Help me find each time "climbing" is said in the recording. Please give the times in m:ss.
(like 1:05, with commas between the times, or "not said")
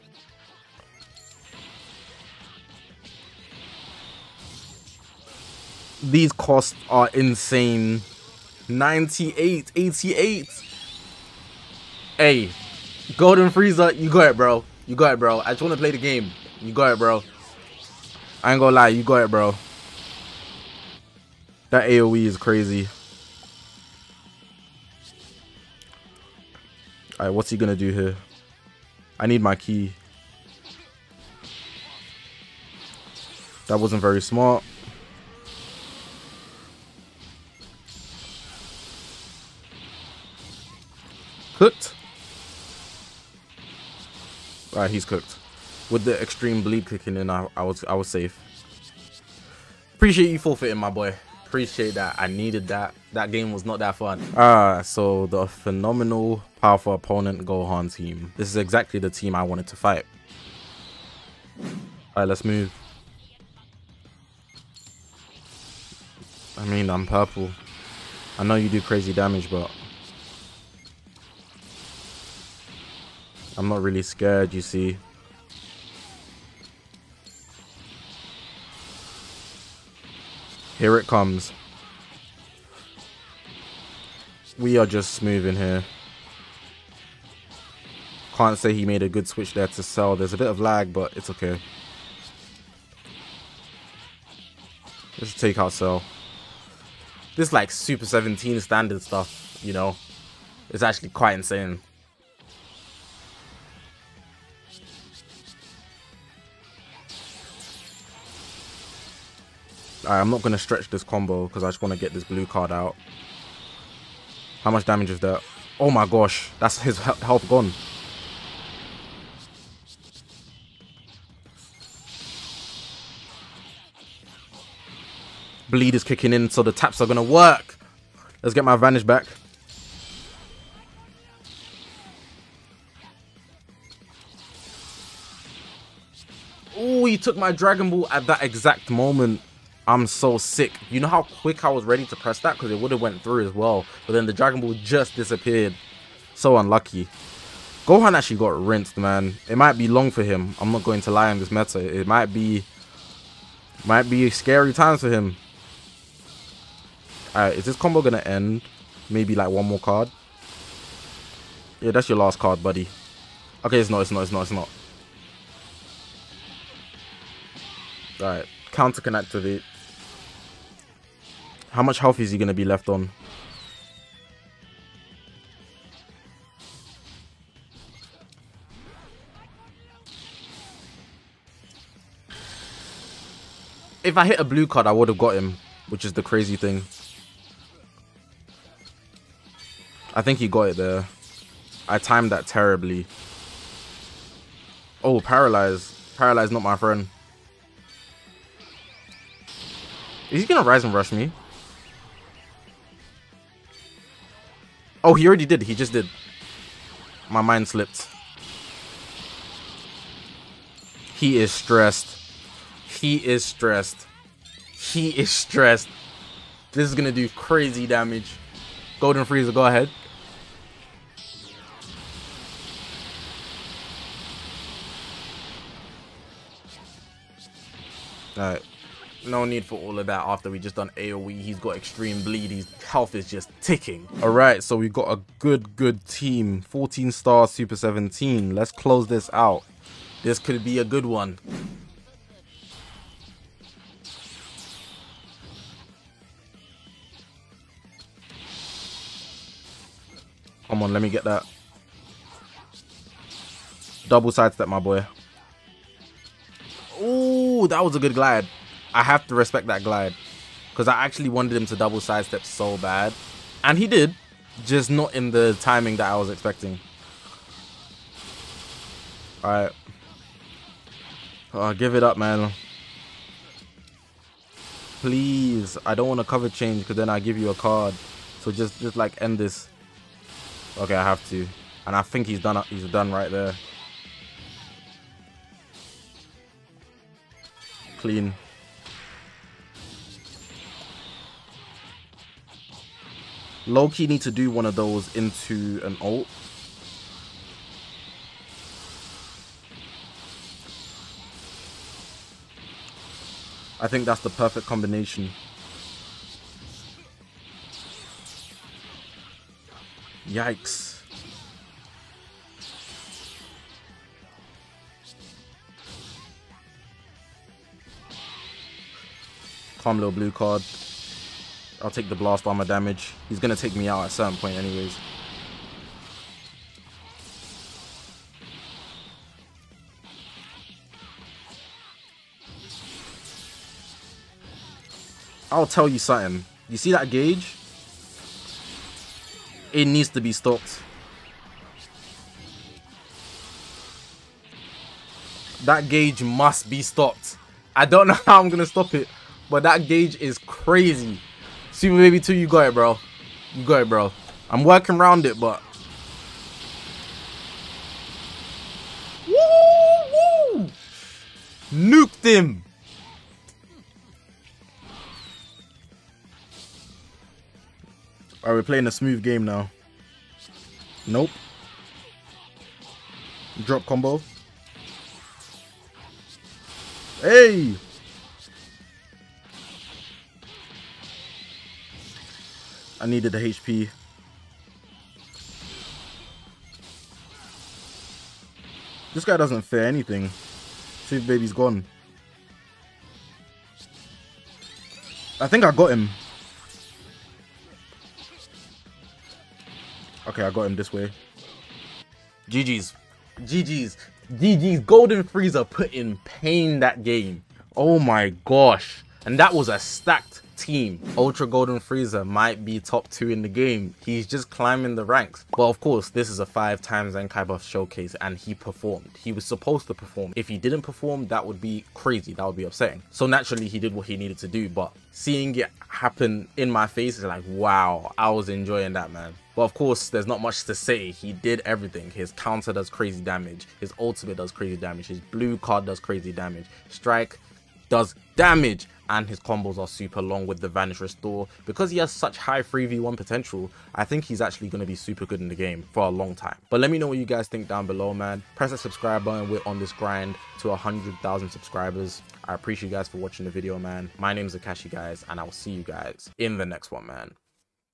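6:54.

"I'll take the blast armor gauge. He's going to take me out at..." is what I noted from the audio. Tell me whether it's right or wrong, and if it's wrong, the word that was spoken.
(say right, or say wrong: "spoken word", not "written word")
wrong: "damage", not "gauge".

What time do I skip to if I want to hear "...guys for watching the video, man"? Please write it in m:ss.
7:32.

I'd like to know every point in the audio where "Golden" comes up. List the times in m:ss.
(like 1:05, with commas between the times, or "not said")
0:13, 3:38, 6:44, 6:51.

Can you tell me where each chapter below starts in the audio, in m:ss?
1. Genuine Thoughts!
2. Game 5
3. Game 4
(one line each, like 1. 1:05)
1. 6:50
2. 3:53
3. 0:53.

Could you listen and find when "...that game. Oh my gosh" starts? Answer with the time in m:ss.
6:46.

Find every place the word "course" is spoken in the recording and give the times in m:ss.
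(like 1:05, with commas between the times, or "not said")
6:55, 7:09.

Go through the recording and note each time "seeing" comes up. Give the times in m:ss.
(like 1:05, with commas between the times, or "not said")
7:05.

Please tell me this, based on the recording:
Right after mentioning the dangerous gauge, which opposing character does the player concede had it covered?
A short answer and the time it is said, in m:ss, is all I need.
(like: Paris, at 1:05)
Super Baby 2, at 5:51.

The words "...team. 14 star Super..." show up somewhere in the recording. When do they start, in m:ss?
3:56.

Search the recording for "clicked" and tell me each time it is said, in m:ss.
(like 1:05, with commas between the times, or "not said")
not said.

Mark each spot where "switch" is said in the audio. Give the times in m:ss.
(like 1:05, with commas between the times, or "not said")
1:29.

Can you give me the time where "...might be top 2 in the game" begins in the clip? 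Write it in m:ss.
6:52.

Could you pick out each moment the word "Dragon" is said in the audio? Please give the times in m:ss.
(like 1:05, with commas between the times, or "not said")
2:17, 2:24.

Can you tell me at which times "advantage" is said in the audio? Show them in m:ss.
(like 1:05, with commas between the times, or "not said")
2:08.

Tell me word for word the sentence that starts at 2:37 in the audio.
Alright, is this combo going to end?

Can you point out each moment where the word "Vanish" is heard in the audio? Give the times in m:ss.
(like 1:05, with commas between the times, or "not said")
7:20.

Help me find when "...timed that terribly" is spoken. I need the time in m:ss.
3:11.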